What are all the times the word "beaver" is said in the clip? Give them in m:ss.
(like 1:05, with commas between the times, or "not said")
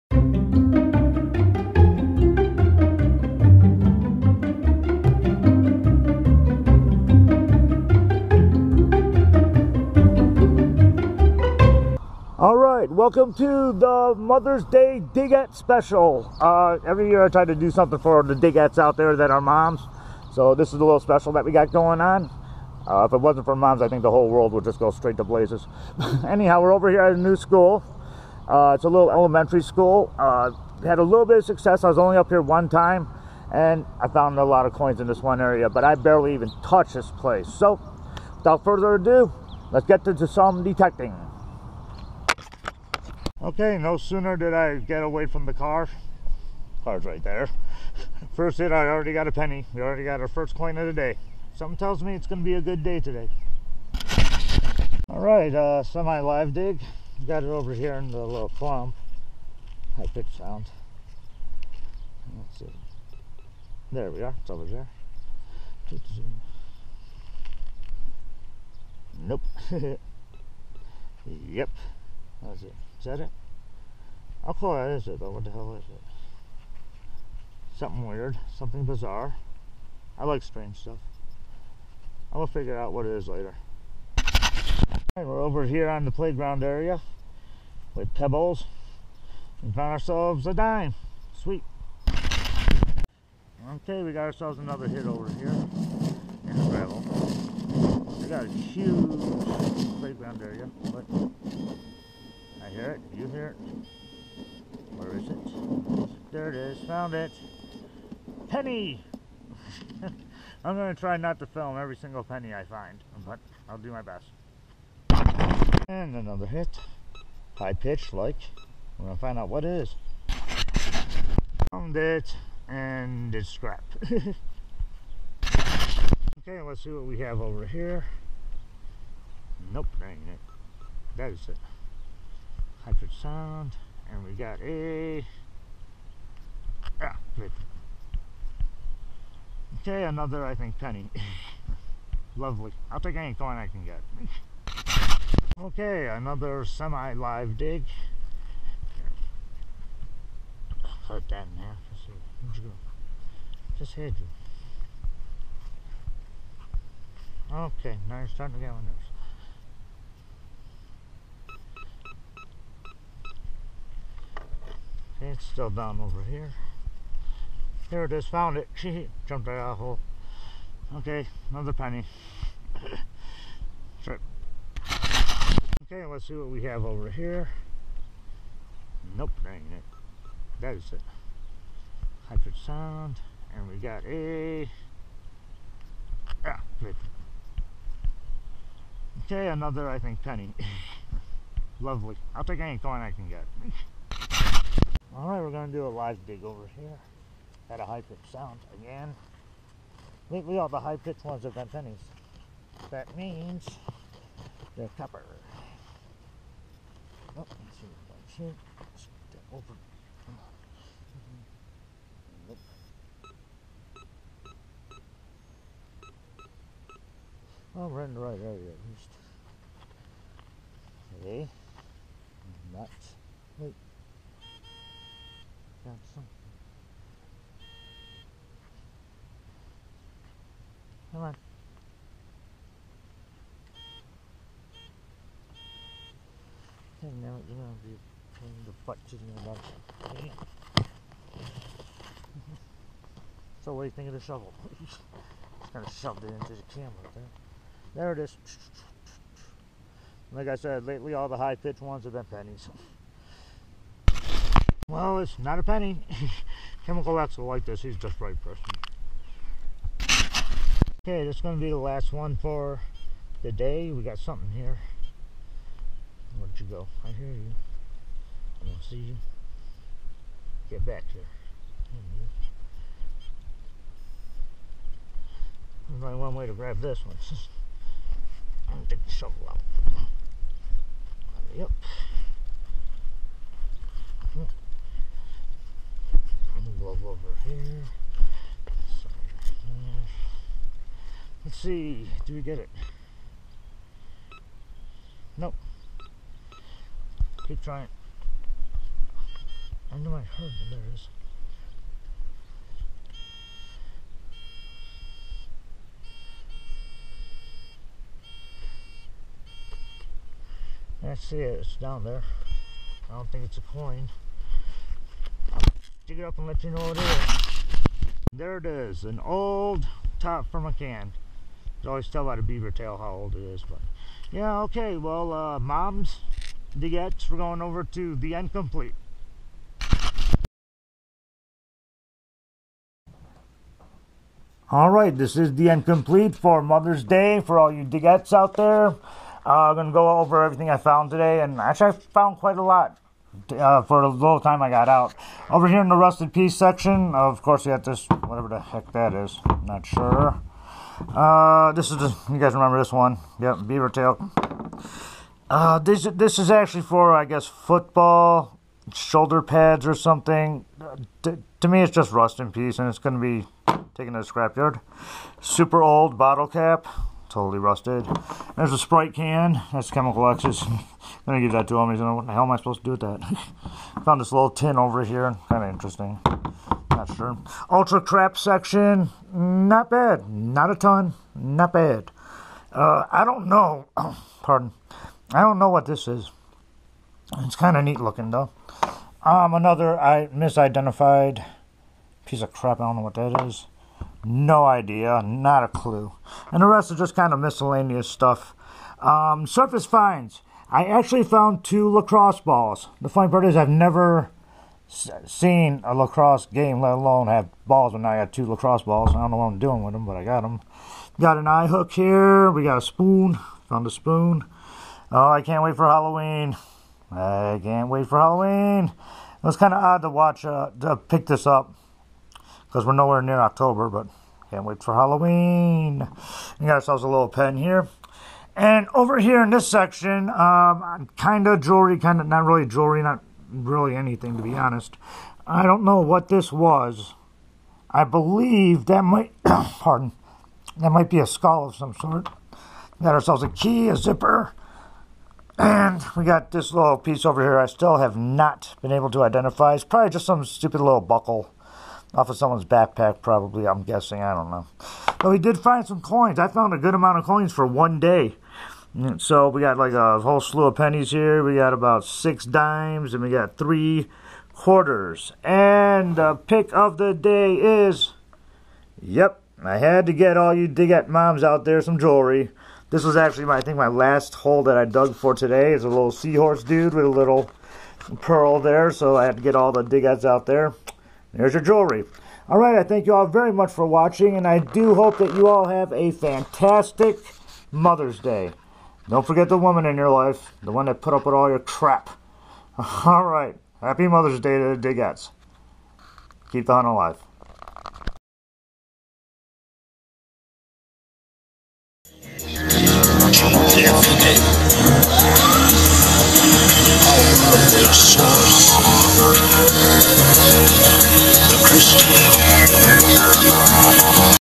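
5:22, 5:53.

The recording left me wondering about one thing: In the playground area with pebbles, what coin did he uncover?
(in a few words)
dime.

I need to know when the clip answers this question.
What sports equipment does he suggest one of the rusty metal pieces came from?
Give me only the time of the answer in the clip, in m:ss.
5:57.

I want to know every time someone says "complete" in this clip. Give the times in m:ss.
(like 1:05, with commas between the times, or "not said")
5:28, 5:35.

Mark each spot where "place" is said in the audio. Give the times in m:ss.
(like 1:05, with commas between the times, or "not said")
0:37.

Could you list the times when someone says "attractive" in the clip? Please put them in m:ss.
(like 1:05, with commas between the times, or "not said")
not said.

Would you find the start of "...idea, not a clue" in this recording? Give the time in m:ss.
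6:34.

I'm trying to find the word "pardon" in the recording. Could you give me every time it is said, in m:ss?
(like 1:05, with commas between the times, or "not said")
6:24, 7:19.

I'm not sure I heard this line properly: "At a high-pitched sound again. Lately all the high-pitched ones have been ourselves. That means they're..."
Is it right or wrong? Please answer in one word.
wrong.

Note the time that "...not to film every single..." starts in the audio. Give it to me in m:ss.
1:51.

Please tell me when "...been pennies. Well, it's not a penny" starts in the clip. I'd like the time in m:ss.
4:12.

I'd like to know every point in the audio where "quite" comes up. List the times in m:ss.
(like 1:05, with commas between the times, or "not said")
5:42.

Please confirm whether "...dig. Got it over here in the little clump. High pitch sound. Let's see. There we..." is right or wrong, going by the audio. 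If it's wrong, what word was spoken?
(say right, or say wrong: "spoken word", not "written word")
right.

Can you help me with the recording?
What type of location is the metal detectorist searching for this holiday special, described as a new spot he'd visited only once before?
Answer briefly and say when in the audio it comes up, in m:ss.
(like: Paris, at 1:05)
elementary school, at 0:29.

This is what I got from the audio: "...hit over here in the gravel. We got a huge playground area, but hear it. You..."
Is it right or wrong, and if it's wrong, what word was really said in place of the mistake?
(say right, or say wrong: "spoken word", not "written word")
right.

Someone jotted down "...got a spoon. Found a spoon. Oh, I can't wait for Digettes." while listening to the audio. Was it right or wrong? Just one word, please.
wrong.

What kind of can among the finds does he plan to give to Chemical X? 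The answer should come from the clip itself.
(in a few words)
Sprite.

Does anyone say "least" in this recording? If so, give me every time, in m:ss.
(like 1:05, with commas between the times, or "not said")
3:38.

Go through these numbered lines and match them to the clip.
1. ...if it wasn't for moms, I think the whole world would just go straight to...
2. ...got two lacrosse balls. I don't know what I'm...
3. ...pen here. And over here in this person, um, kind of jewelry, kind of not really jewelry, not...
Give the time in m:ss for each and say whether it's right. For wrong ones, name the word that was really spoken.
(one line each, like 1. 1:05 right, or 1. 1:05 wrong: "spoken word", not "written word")
1. 0:23 right
2. 6:48 right
3. 7:07 wrong: "section", not "person".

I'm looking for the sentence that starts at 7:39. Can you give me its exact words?
So we got like a whole slew of pennies here.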